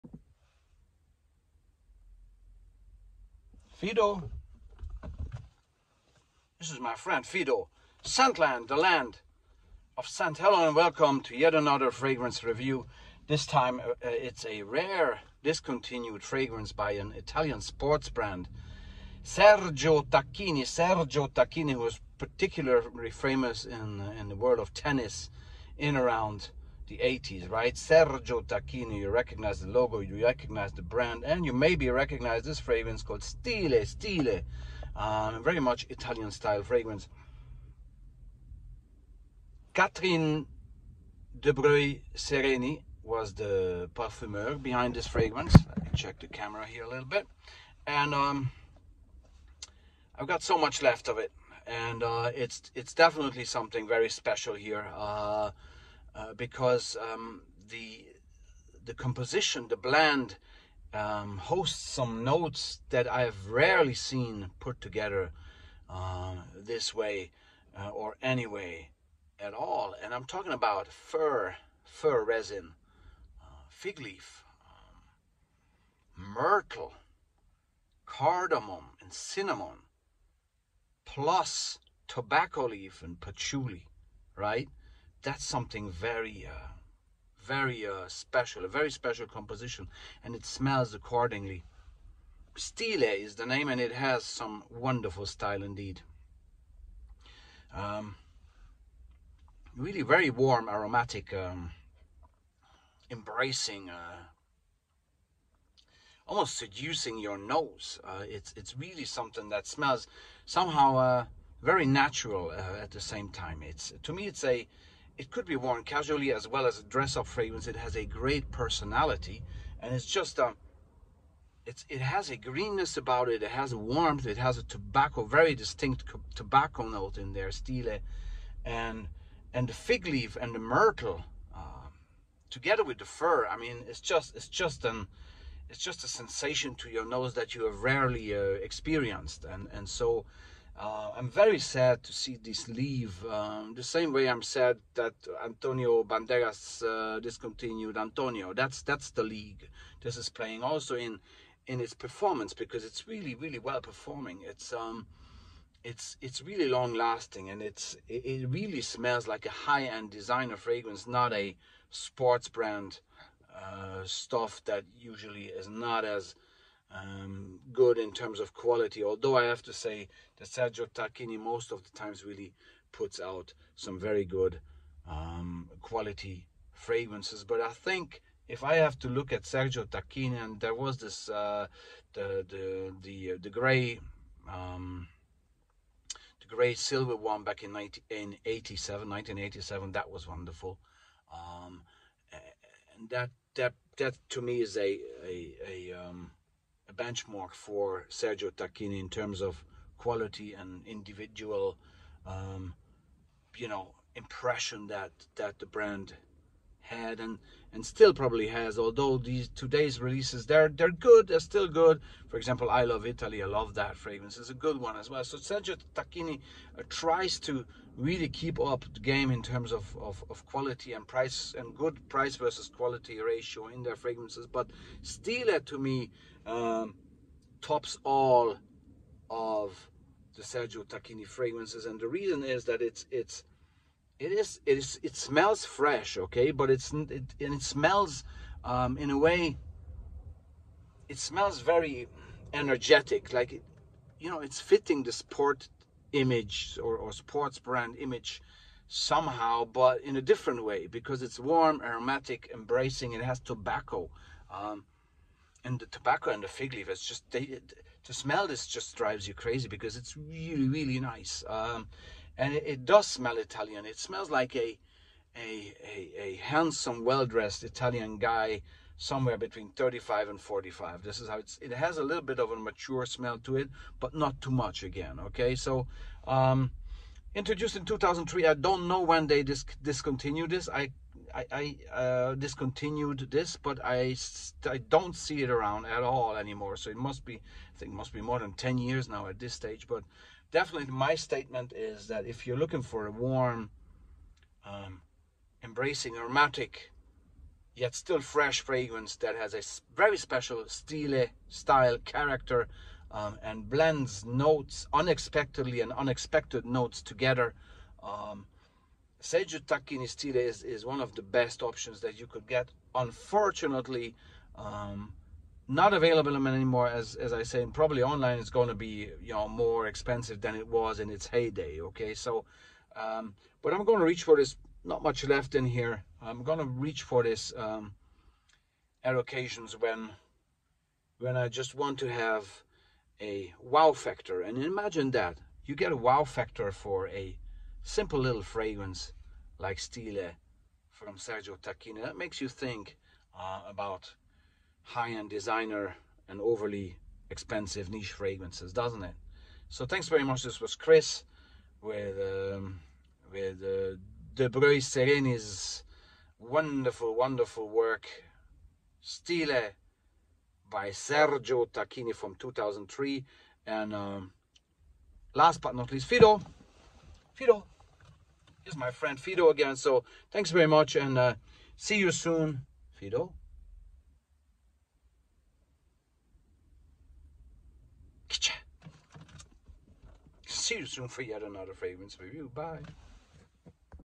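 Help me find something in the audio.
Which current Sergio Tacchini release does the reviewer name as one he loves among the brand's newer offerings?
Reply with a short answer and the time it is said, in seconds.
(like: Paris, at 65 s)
I Love Italy, at 212 s.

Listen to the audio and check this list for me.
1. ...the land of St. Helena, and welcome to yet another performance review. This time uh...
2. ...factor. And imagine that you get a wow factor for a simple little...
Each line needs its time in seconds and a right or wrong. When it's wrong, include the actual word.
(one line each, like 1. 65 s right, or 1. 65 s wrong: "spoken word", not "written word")
1. 8 s wrong: "fragrance", not "performance"
2. 333 s right.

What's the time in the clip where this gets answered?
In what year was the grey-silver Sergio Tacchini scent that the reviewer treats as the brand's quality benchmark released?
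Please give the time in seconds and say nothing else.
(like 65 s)
189 s.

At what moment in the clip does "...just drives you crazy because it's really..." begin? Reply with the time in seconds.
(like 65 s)
258 s.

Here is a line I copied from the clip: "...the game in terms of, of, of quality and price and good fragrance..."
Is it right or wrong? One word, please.
wrong.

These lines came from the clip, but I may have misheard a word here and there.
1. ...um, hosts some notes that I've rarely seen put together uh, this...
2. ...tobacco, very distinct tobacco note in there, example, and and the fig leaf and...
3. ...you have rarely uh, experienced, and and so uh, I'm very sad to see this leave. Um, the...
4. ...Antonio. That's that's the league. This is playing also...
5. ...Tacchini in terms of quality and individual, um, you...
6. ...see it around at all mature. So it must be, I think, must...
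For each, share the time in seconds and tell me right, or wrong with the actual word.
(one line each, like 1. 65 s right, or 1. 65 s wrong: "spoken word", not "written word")
1. 60 s right
2. 124 s wrong: "stile", not "example"
3. 137 s right
4. 147 s right
5. 198 s right
6. 285 s wrong: "anymore", not "mature".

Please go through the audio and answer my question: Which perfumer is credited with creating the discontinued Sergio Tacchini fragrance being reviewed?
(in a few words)
Catherine de Bruy Sereni.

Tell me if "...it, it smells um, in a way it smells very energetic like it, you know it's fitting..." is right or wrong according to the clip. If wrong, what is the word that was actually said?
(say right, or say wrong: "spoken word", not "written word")
right.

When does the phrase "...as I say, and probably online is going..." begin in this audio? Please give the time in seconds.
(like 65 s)
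317 s.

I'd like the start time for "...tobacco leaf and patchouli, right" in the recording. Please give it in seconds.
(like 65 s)
82 s.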